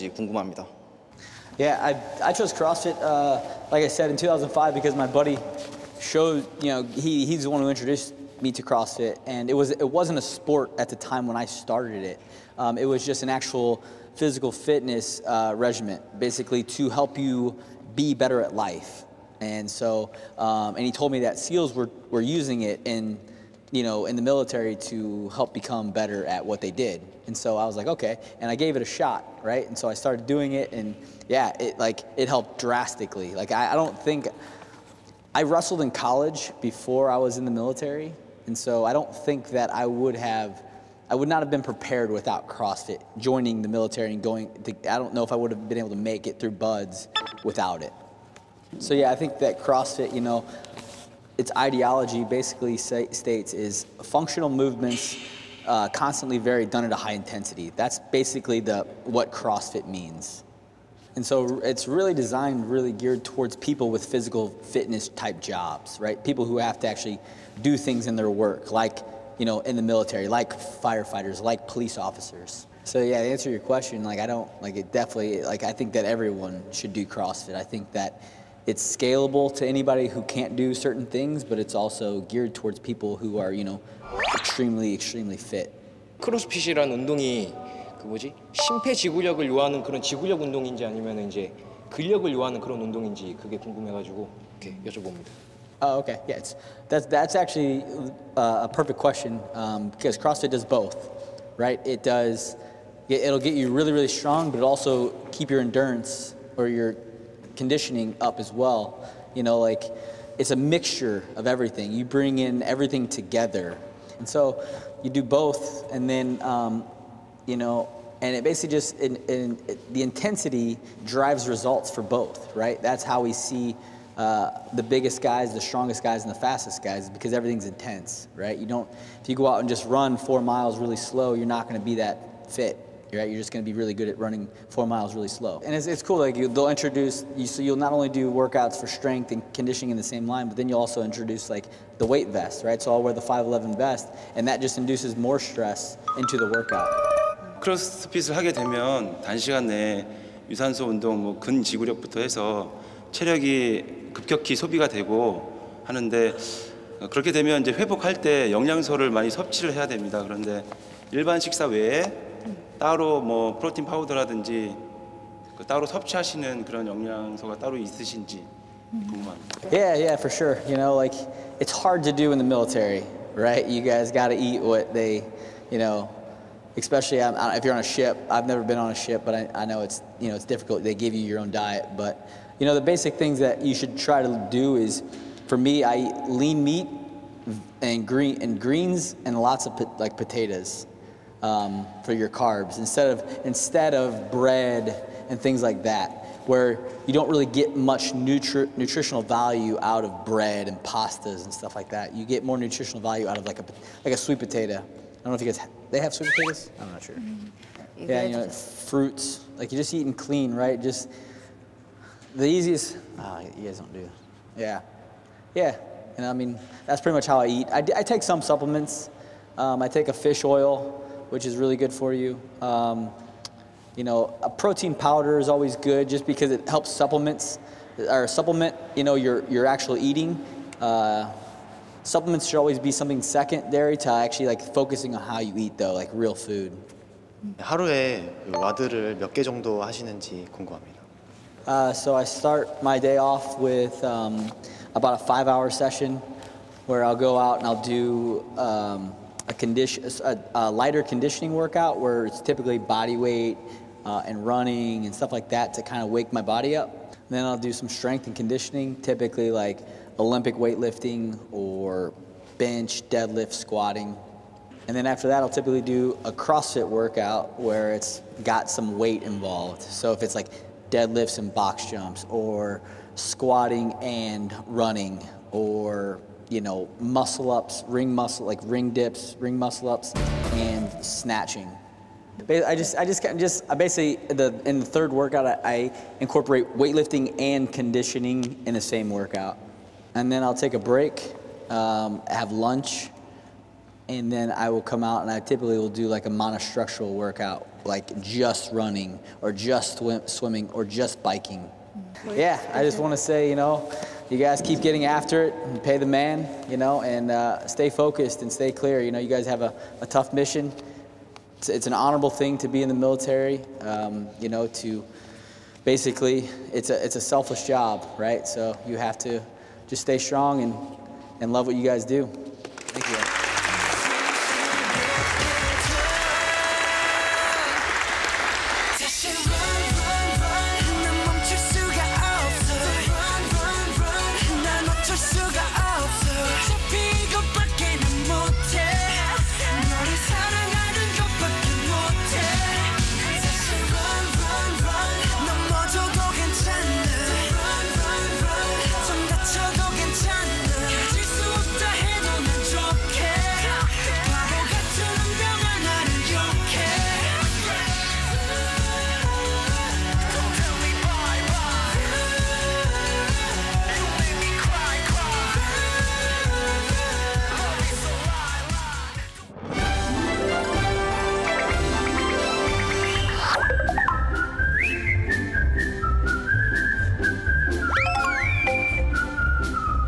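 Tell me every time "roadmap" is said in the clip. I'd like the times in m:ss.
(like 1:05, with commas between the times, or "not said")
not said.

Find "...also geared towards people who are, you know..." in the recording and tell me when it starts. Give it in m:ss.
1:21.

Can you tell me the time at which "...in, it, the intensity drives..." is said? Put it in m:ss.
1:59.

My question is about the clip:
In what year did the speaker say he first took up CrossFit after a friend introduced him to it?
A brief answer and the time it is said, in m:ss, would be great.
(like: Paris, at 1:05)
2005, at 0:04.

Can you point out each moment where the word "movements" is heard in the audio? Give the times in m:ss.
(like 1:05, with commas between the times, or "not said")
0:54.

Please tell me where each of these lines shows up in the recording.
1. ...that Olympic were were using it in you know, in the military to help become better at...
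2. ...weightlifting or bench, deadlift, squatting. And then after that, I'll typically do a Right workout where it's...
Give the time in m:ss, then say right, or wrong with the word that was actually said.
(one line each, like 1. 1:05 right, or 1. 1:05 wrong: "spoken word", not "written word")
1. 0:21 wrong: "SEALs", not "Olympic"
2. 4:20 wrong: "CrossFit", not "Right".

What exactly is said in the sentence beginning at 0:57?
That's basically the, what CrossFit means.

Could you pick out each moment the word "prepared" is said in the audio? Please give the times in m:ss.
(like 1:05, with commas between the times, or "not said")
0:41.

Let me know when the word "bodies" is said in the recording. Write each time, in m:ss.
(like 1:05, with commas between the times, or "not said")
not said.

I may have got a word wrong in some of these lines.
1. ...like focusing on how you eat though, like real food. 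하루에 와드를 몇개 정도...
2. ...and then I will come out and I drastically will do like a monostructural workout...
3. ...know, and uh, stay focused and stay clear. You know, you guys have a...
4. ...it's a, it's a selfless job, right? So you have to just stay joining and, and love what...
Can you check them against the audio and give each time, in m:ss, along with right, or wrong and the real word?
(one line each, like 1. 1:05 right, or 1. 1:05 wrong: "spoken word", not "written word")
1. 3:54 right
2. 4:54 wrong: "typically", not "drastically"
3. 5:06 right
4. 5:16 wrong: "strong", not "joining".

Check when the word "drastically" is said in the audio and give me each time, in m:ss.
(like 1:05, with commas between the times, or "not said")
0:32.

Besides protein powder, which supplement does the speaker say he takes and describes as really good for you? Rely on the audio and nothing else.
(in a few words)
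Fish oil.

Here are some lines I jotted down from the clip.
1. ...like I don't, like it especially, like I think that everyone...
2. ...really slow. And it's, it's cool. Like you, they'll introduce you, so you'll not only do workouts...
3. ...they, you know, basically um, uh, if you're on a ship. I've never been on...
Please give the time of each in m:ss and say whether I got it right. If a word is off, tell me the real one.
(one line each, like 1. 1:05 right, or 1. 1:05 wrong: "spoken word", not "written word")
1. 1:14 wrong: "definitely", not "especially"
2. 2:15 right
3. 2:54 wrong: "especially", not "basically".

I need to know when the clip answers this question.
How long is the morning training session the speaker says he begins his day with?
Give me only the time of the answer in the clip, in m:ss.
4:05.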